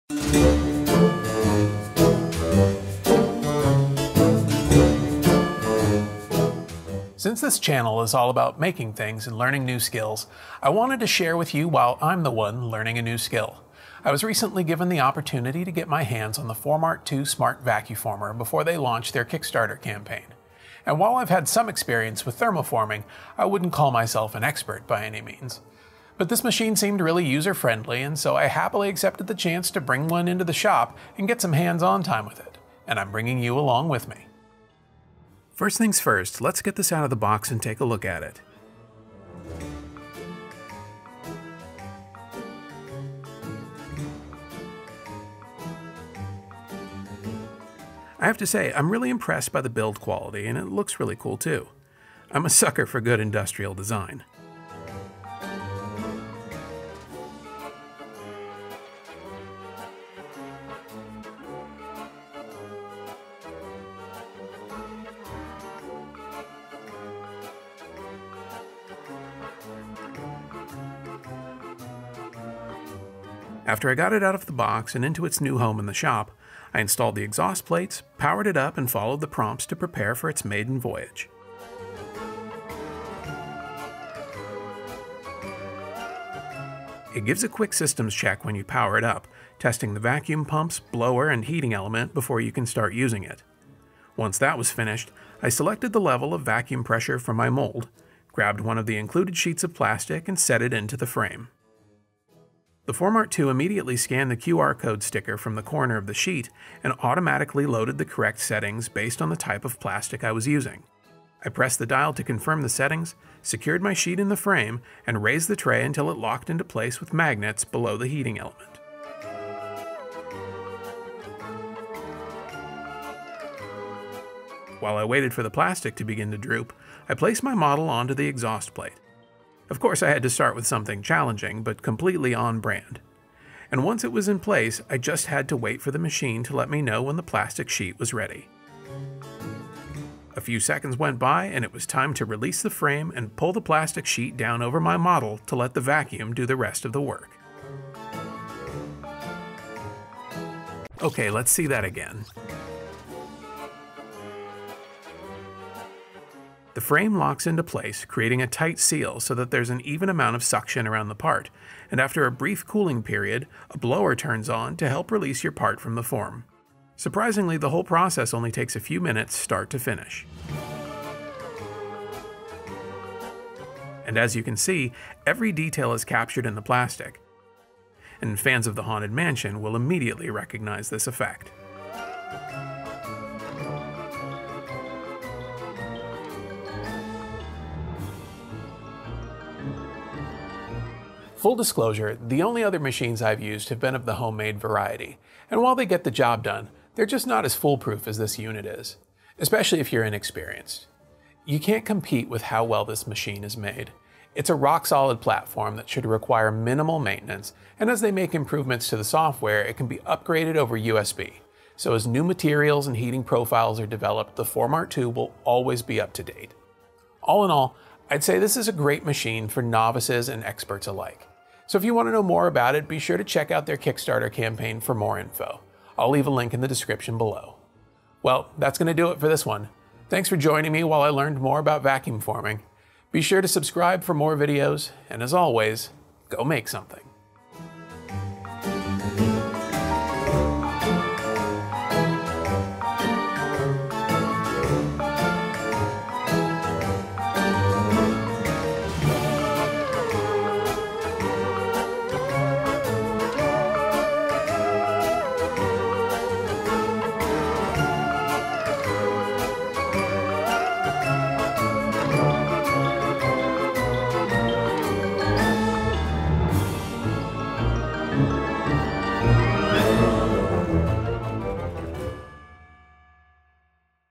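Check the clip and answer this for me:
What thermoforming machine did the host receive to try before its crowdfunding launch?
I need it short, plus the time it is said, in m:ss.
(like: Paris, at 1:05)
Formart 2 Smart Vacuformer, at 0:16.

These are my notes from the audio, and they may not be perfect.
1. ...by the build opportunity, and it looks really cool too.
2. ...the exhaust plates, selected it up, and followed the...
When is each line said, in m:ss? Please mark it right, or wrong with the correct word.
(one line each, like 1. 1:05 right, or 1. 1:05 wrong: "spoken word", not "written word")
1. 0:49 wrong: "quality", not "opportunity"
2. 1:17 wrong: "powered", not "selected".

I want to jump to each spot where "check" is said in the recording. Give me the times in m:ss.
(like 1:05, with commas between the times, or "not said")
1:28, 3:43.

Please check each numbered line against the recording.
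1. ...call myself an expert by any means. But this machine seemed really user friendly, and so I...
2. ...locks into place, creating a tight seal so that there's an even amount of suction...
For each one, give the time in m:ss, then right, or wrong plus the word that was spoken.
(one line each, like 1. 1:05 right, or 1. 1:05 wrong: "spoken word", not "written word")
1. 0:23 right
2. 2:37 right.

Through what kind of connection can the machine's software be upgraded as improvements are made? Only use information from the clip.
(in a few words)
USB.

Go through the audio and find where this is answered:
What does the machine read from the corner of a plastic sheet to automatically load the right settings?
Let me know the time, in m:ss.
1:44.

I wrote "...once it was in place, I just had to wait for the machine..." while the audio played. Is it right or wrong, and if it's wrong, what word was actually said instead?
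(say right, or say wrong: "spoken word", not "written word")
right.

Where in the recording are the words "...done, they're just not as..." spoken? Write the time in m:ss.
3:16.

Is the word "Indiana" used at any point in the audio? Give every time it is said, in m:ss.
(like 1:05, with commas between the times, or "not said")
not said.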